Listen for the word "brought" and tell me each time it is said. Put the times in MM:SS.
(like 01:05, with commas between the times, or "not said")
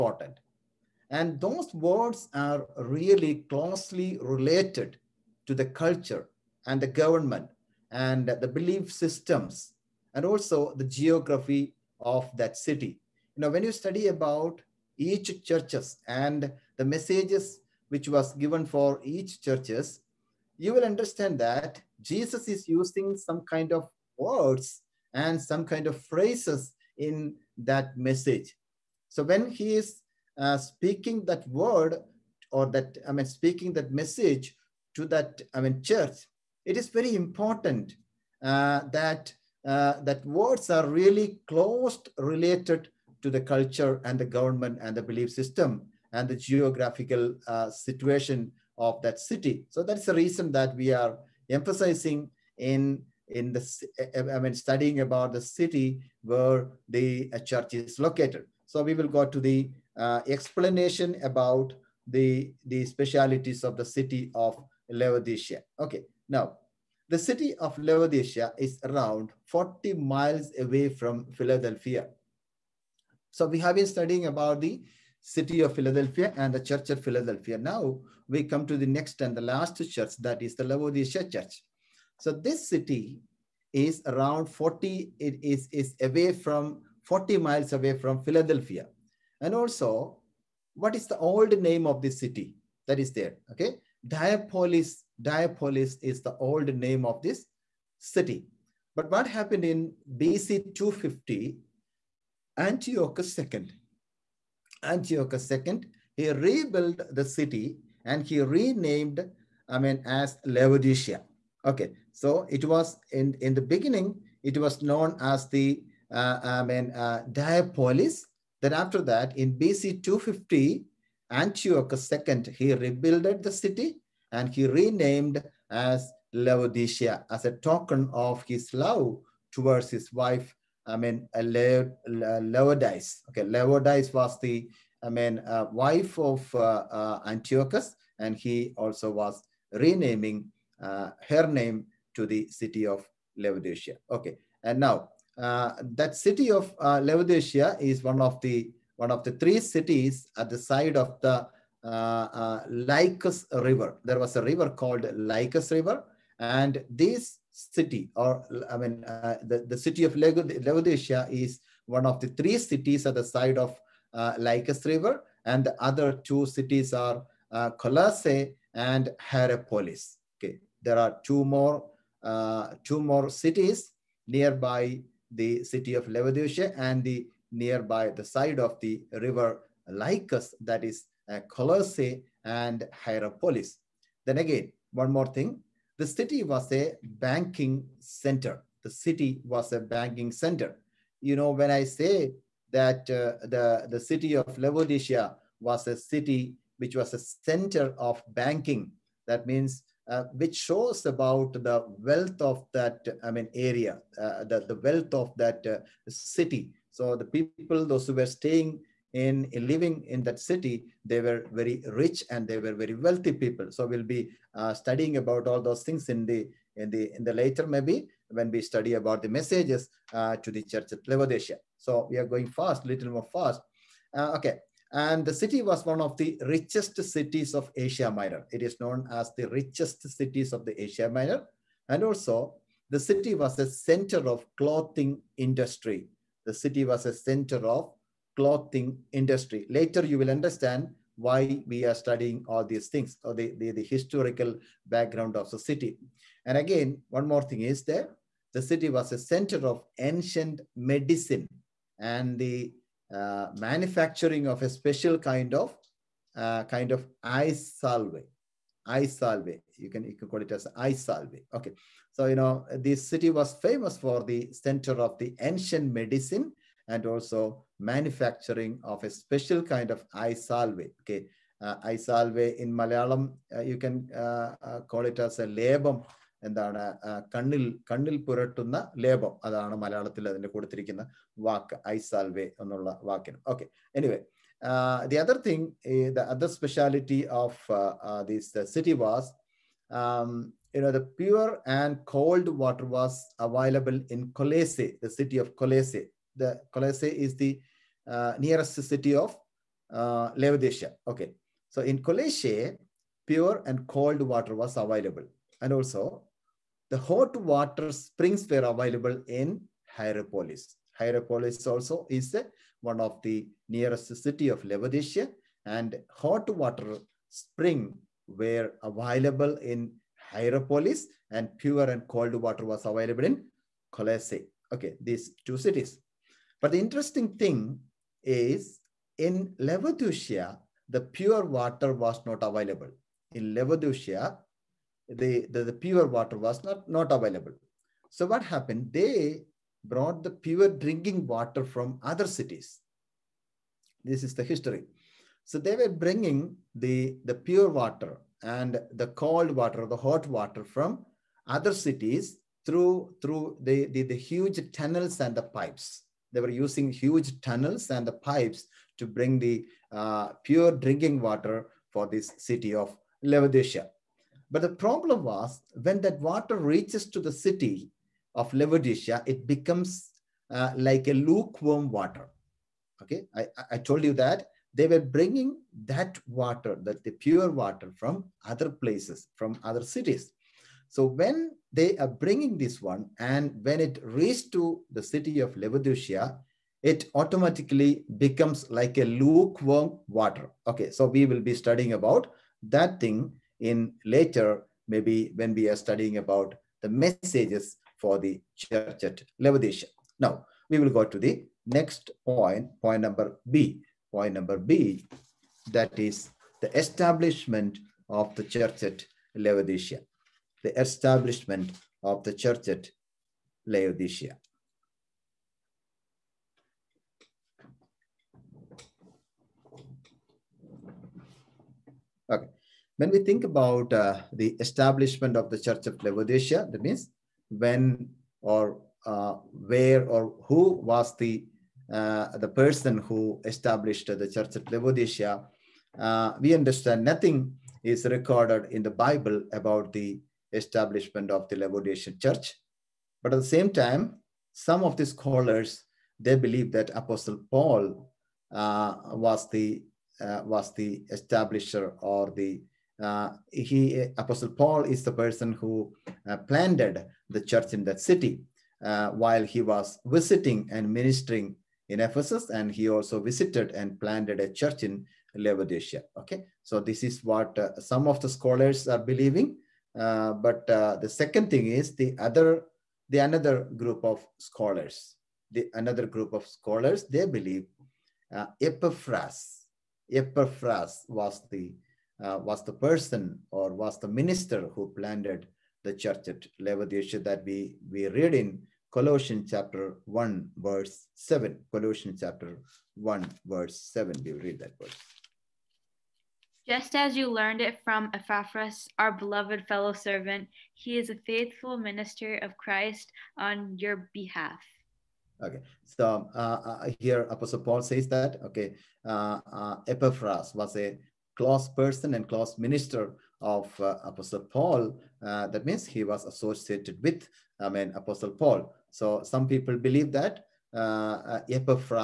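05:39.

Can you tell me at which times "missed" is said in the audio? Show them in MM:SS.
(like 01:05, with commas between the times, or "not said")
not said.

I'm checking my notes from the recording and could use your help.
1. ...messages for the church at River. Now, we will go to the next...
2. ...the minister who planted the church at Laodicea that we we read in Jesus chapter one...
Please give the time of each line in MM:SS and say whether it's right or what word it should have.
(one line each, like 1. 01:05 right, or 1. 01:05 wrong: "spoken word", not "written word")
1. 06:36 wrong: "Laodicea", not "River"
2. 08:03 wrong: "Colossians", not "Jesus".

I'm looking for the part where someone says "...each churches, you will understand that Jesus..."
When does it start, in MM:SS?
00:19.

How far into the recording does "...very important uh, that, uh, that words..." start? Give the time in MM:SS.
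00:36.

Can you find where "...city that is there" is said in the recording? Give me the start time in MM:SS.
01:32.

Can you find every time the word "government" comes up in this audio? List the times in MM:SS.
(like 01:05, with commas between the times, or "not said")
00:06, 00:44.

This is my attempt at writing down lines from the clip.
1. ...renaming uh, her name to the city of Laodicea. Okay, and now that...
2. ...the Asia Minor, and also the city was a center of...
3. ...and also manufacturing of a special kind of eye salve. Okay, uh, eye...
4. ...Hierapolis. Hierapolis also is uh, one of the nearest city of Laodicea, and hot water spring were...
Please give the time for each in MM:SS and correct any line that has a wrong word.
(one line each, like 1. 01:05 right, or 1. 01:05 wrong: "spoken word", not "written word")
1. 02:19 right
2. 03:50 right
3. 04:26 right
4. 05:09 right.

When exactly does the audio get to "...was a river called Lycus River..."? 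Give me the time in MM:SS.
02:34.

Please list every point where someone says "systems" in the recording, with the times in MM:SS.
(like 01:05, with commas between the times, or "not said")
00:08, 00:45.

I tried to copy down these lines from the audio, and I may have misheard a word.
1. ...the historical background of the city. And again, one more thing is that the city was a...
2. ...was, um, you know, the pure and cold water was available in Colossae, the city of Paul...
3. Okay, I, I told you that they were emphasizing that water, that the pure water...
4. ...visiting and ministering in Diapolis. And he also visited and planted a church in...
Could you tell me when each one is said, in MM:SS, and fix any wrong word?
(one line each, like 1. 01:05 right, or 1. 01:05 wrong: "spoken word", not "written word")
1. 04:03 right
2. 04:48 wrong: "Colossae", not "Paul"
3. 06:13 wrong: "bringing", not "emphasizing"
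4. 07:40 wrong: "Ephesus", not "Diapolis".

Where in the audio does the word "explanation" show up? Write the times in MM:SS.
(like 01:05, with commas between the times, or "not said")
01:00.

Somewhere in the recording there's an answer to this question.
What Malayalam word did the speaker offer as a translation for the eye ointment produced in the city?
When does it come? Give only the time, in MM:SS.
04:35.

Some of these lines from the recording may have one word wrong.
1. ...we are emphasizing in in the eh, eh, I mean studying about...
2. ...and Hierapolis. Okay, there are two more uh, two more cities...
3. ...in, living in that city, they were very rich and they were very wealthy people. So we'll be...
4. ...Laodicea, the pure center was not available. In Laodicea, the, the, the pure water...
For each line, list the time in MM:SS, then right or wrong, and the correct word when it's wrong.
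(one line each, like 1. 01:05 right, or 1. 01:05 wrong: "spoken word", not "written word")
1. 00:50 right
2. 02:48 right
3. 03:29 right
4. 05:29 wrong: "water", not "center".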